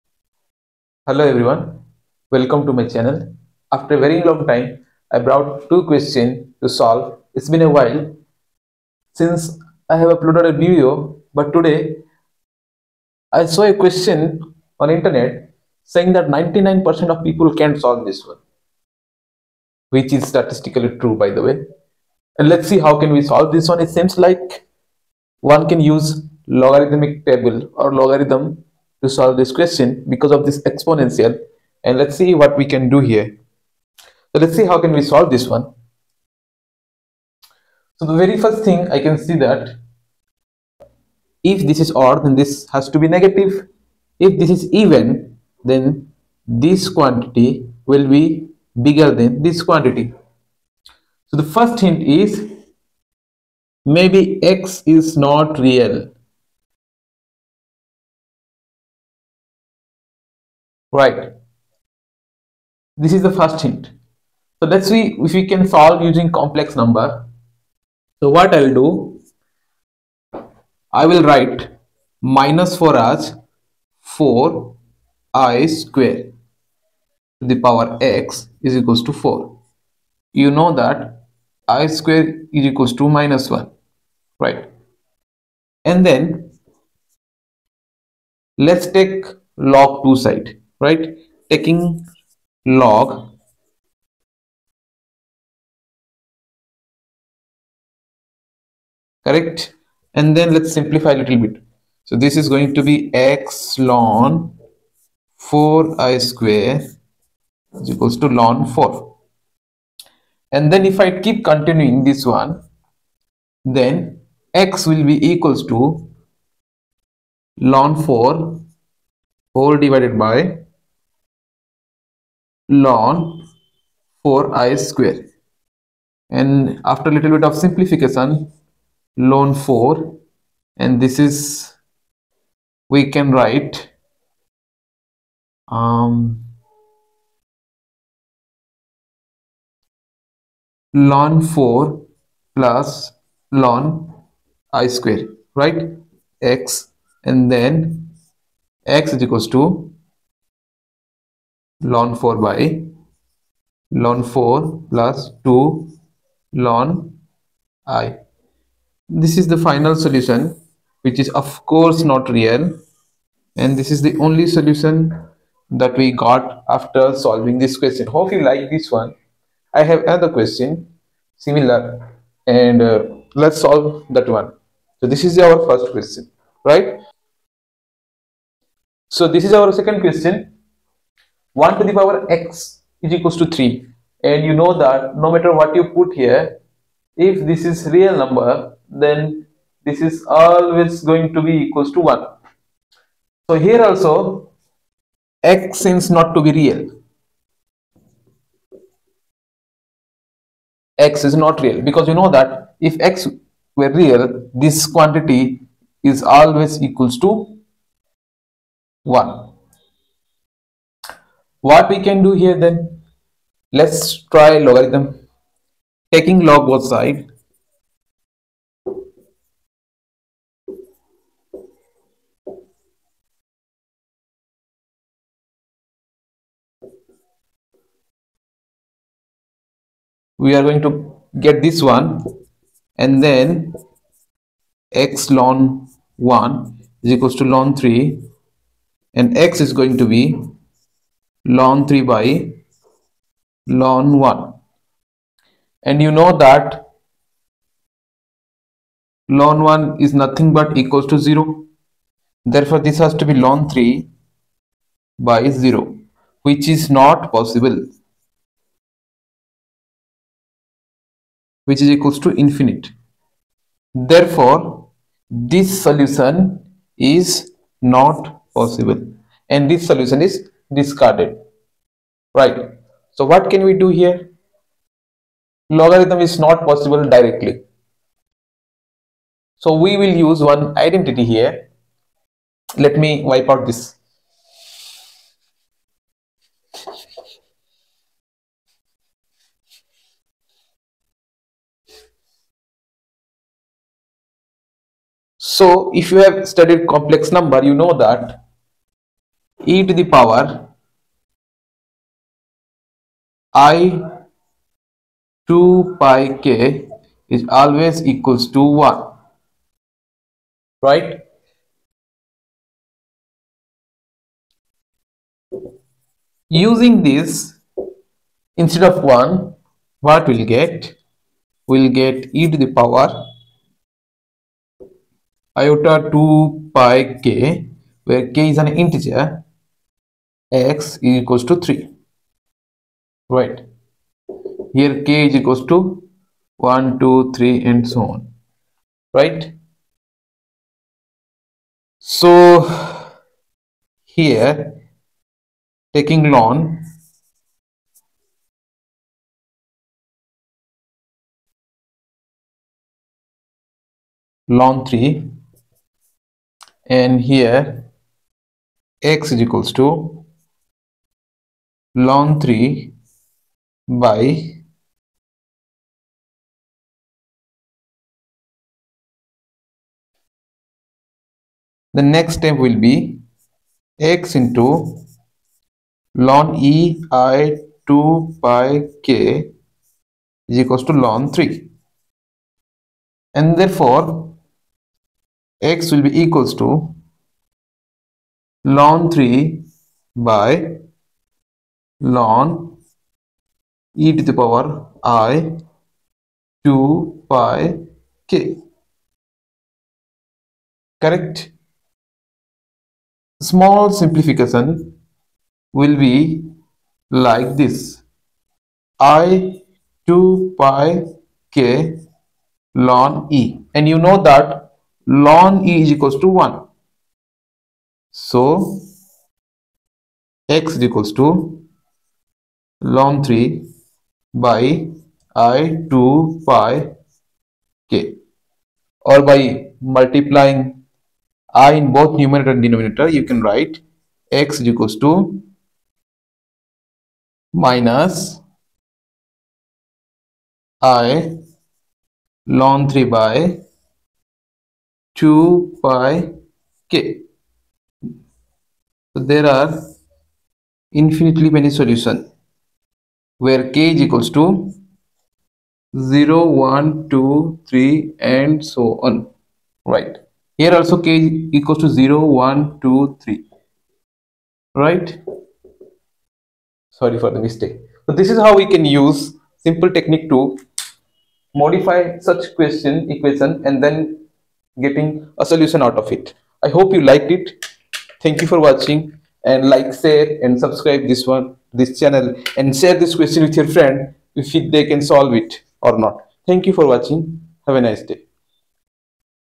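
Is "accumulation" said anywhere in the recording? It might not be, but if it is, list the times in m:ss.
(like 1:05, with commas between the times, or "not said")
not said.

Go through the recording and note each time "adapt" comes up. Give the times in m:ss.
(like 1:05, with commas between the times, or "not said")
not said.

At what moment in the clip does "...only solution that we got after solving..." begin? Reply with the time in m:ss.
2:44.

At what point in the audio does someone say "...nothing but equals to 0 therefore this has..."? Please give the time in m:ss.
4:10.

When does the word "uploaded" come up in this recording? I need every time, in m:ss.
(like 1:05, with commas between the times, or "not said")
0:10.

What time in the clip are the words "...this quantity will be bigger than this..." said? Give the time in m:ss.
0:46.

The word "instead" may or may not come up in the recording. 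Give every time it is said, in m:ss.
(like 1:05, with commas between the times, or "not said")
5:18.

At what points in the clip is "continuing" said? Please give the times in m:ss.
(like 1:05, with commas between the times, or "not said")
1:51.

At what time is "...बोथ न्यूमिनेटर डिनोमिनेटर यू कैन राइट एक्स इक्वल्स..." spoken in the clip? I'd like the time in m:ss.
7:11.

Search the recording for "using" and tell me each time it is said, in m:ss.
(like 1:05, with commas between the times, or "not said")
1:06, 5:16.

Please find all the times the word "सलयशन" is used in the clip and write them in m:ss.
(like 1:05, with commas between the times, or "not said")
7:31.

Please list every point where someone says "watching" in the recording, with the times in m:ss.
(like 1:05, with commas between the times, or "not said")
7:58, 8:06.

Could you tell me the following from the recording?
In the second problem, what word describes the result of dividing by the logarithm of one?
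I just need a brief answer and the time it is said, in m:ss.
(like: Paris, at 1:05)
infinite, at 4:22.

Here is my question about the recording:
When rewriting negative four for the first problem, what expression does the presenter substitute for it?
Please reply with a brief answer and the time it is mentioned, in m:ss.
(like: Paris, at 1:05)
4i squared, at 1:14.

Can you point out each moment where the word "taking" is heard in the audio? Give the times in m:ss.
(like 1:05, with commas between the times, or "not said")
1:31, 3:36, 5:45.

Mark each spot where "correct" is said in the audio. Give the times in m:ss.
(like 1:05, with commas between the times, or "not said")
1:39, 6:41.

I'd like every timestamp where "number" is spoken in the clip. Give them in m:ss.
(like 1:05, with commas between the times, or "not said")
1:06, 3:08, 4:57.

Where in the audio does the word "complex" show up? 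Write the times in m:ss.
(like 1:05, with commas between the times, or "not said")
1:06, 4:56.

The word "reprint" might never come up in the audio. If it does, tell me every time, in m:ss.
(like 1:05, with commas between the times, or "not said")
not said.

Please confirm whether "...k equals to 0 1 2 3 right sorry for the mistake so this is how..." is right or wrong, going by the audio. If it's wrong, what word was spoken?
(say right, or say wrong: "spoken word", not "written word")
right.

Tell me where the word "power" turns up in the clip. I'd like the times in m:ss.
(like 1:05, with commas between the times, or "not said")
1:17, 3:01, 5:00, 5:22, 6:34.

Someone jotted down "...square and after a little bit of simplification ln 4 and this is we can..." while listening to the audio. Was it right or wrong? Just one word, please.
right.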